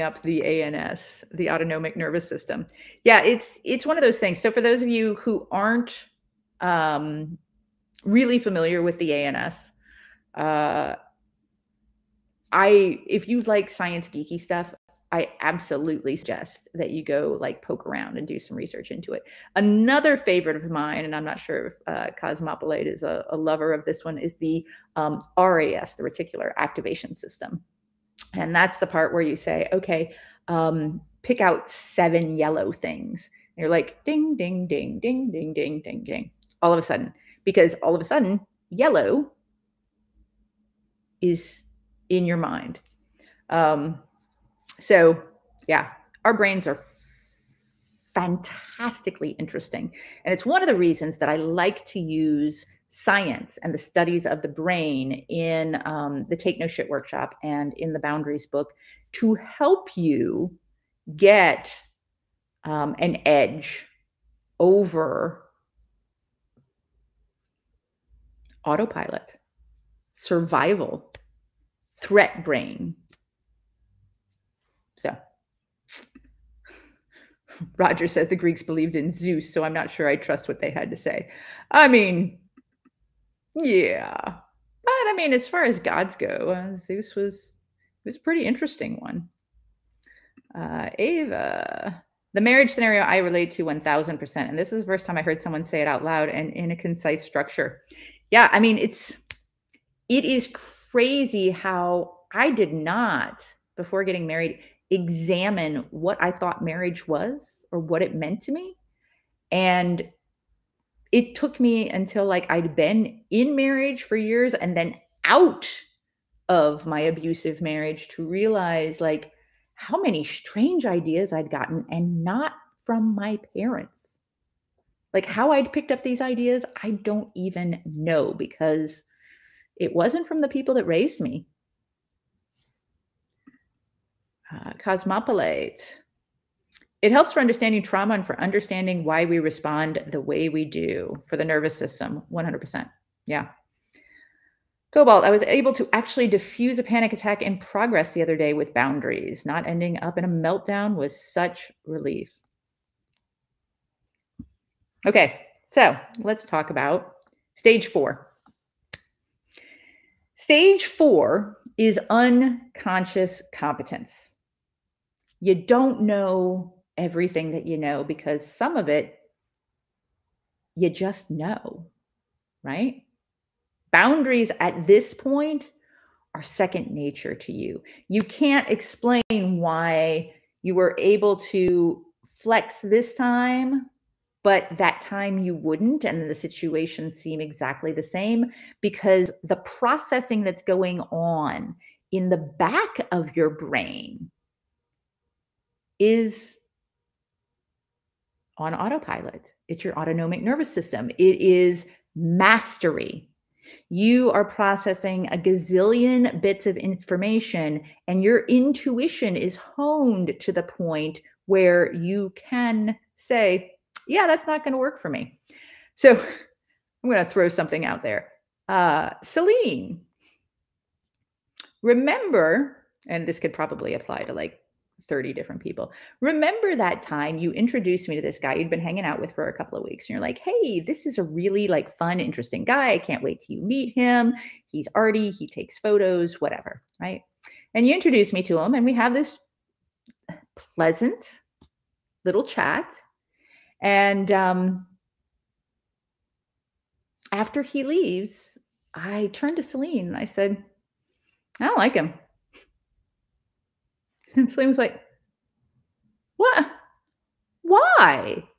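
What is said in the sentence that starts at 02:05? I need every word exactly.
Like how I'd picked up these ideas, I don't even know because it wasn't from the people that raised me.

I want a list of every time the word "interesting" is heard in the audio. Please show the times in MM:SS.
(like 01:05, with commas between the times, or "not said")
00:49, 01:28, 03:52.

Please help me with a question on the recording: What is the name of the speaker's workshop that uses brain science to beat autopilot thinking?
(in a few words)
Take No Shit.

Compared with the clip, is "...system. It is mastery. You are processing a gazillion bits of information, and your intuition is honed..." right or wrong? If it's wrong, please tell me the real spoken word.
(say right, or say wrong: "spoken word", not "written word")
right.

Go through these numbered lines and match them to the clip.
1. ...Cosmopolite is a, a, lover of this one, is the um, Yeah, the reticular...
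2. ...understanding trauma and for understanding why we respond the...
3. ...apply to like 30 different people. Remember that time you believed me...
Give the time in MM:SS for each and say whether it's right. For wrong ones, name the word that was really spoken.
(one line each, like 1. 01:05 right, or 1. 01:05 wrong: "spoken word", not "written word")
1. 00:22 wrong: "RAS", not "Yeah"
2. 02:17 right
3. 03:43 wrong: "introduced", not "believed".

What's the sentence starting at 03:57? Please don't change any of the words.
And you introduce me to him and we have this pleasant little chat.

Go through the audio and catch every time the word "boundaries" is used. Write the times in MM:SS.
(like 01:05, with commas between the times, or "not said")
00:57, 02:28, 02:53.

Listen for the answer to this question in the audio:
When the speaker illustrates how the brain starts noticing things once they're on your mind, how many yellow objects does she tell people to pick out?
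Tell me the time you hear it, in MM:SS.
00:31.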